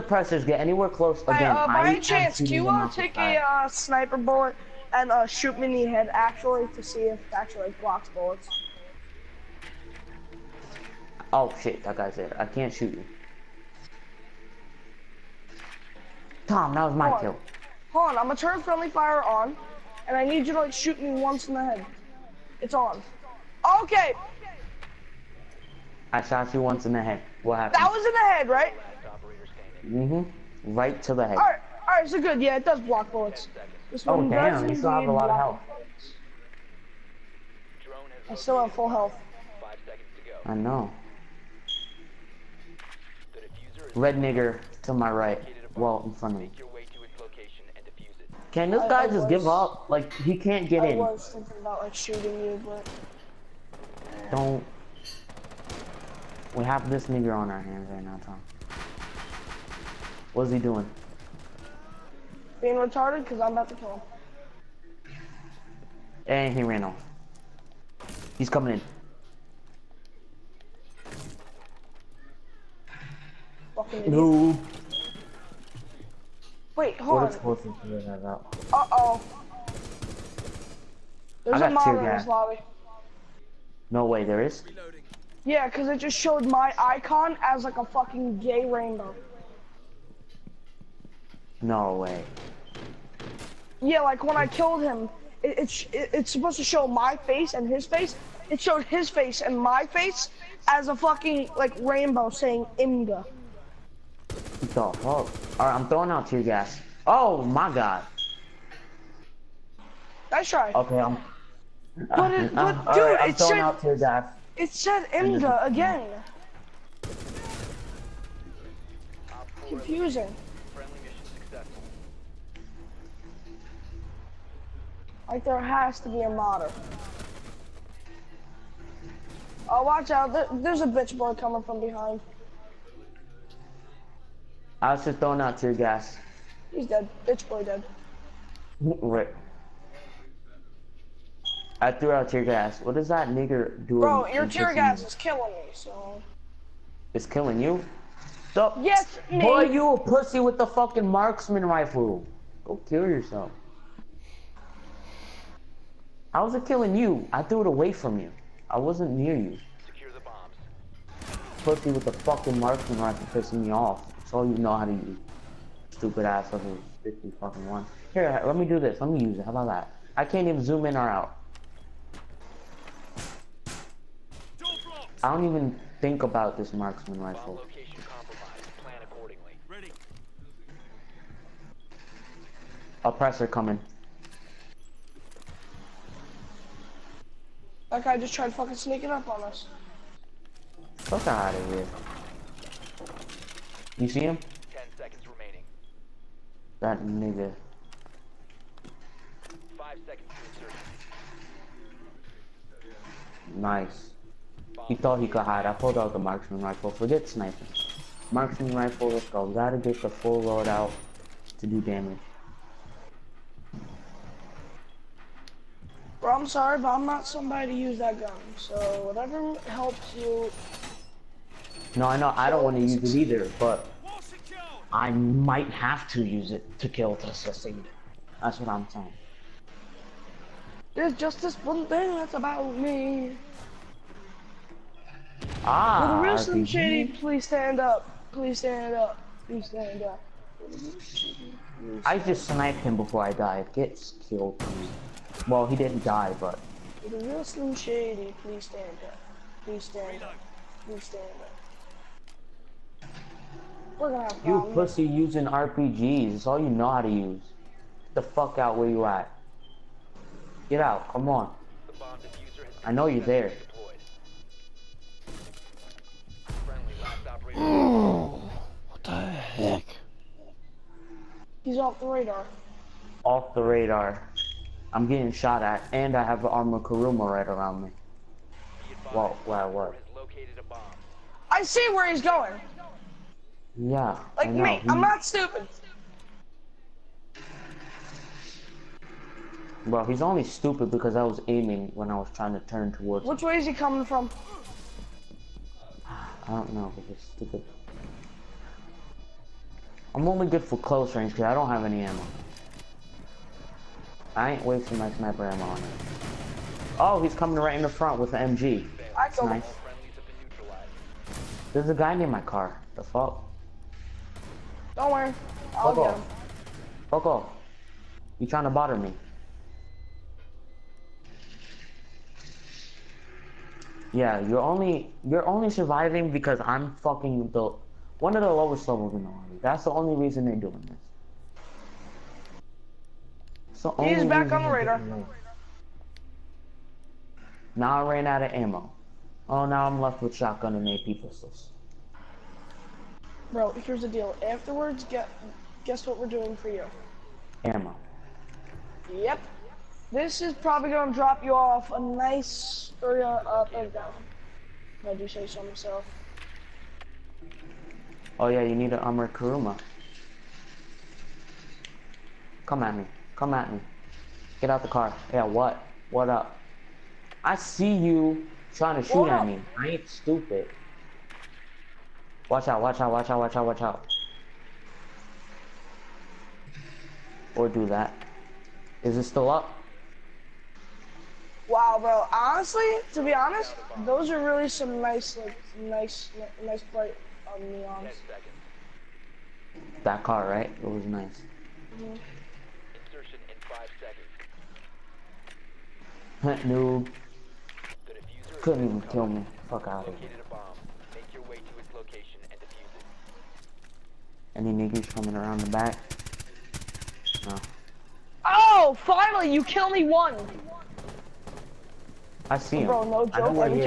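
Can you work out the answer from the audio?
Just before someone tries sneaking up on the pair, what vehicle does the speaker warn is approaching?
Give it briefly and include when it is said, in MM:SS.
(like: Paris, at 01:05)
Oppressor, at 03:03.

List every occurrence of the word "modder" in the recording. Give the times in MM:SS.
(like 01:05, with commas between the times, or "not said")
02:06.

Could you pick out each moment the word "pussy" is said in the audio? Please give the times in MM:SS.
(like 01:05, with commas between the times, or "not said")
02:29, 02:41, 04:14.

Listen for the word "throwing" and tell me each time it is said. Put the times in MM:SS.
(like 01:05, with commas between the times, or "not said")
01:45, 02:15.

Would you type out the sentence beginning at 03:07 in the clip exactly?
That guy just tried to fucking sneaking up on us.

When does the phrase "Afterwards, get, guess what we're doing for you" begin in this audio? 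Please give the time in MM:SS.
05:44.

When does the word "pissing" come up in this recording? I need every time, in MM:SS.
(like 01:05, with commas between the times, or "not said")
02:43.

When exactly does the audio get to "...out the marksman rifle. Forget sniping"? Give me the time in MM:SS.
03:25.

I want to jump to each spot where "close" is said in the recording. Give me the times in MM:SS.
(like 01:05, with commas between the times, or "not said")
00:00, 05:00.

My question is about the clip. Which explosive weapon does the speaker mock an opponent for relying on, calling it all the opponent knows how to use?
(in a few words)
RPGs.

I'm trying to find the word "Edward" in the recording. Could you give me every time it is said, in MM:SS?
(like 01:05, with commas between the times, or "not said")
not said.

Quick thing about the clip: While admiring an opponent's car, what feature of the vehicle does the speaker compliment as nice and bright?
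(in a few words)
neons.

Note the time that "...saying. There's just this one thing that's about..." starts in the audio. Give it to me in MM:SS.
03:48.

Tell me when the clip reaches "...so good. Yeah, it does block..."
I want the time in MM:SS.
00:32.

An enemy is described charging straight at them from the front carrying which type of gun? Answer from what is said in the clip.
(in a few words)
MG.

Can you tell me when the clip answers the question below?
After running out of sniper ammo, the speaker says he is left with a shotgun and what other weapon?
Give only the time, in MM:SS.
05:40.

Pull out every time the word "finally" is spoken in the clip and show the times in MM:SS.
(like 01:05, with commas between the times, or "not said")
06:49.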